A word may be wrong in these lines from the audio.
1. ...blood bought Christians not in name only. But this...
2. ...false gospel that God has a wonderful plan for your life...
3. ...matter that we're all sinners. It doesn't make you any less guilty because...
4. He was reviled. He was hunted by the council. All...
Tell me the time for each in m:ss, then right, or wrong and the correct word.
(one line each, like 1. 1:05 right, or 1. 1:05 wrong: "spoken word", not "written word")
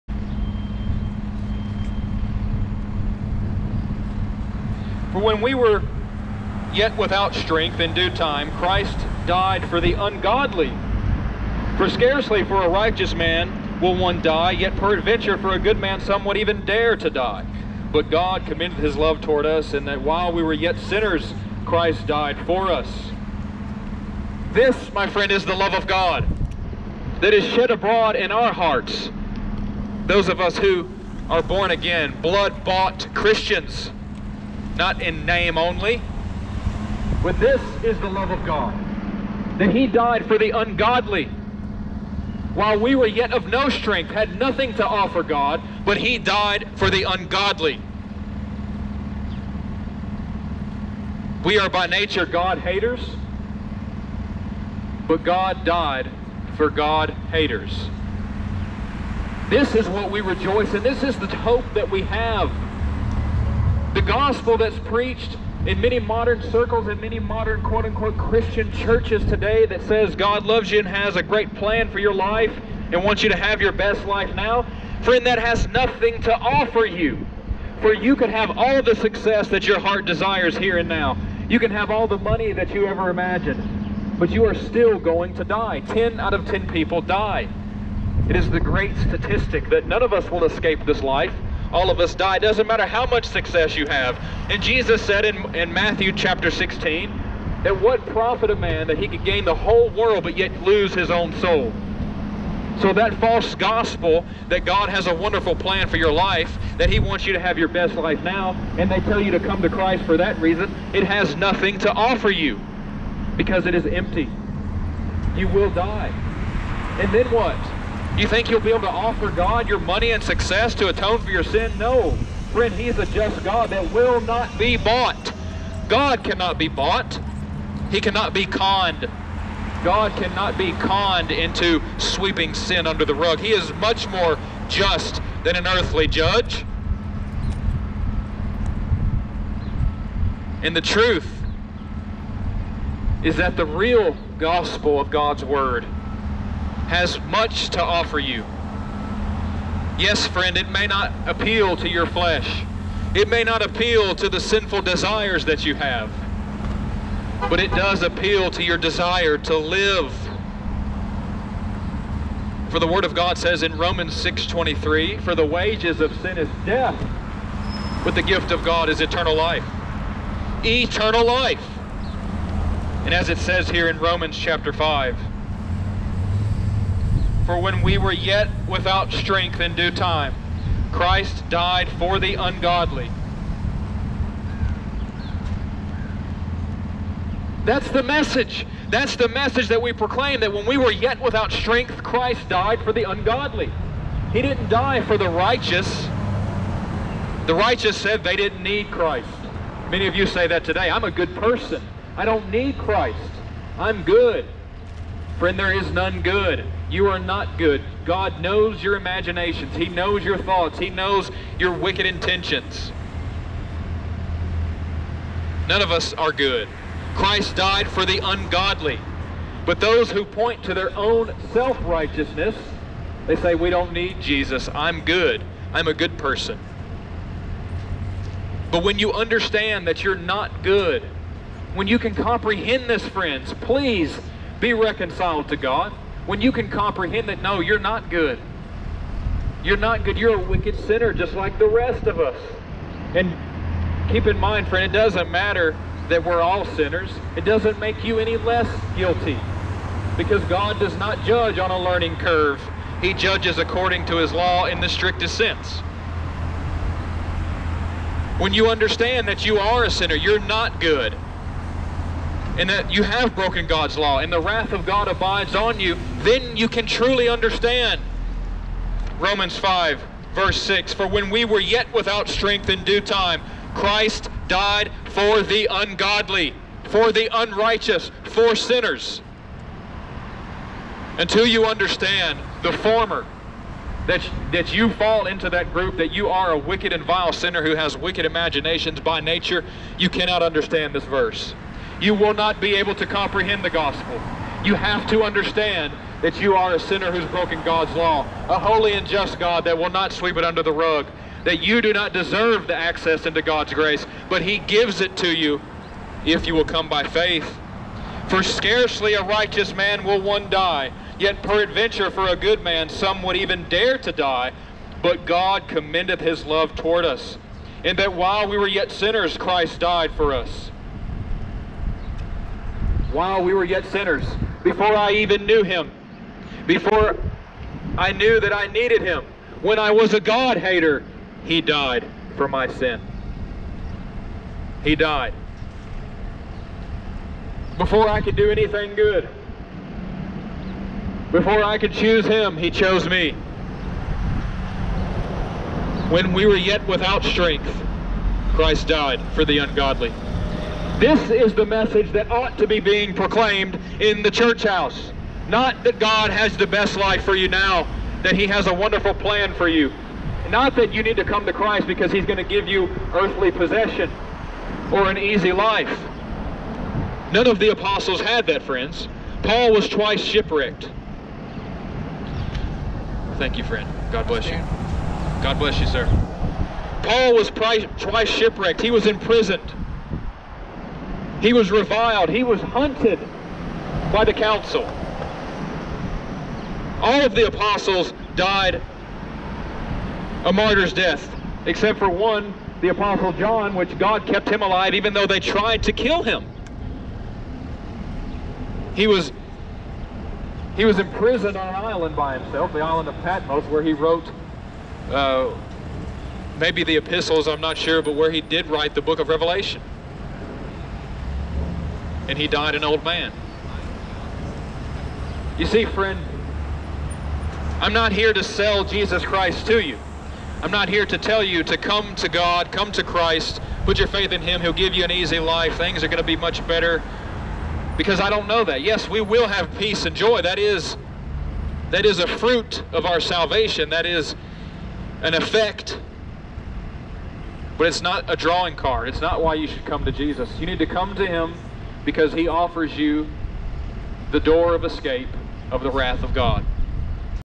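1. 0:32 right
2. 1:43 right
3. 4:05 right
4. 6:21 right.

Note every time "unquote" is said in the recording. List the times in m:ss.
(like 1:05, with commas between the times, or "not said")
1:07.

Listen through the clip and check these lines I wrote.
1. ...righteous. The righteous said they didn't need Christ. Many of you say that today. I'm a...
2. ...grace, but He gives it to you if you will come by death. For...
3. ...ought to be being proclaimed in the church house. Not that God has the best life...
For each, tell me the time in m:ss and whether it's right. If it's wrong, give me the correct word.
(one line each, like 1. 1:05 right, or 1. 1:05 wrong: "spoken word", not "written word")
1. 3:15 right
2. 5:03 wrong: "faith", not "death"
3. 5:52 right.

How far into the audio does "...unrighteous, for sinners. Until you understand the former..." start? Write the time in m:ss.
4:37.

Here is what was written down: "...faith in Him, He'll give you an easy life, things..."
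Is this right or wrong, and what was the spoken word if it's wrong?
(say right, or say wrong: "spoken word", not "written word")
right.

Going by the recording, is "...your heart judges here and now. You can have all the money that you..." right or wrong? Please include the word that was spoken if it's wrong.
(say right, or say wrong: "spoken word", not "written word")
wrong: "desires", not "judges".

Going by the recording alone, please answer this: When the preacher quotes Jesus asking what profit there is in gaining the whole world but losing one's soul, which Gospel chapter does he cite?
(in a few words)
Matthew 16.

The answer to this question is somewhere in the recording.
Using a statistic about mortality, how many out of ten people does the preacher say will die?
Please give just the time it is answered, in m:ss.
1:25.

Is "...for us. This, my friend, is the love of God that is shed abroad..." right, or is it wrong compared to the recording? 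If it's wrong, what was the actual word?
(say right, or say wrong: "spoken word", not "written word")
right.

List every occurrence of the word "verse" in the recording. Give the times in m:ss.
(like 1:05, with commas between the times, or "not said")
4:30, 4:51.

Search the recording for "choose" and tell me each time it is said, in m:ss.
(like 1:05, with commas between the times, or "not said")
5:41.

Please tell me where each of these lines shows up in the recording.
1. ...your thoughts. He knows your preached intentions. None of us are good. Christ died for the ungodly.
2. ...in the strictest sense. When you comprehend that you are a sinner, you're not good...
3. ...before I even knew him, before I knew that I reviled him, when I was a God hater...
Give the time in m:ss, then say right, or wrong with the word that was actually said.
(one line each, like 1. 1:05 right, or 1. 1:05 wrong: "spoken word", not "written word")
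1. 3:30 wrong: "wicked", not "preached"
2. 4:14 wrong: "understand", not "comprehend"
3. 5:24 wrong: "needed", not "reviled".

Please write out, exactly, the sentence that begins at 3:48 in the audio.
But when you understand that you're not good, when you can comprehend this, friends, please be reconciled to God.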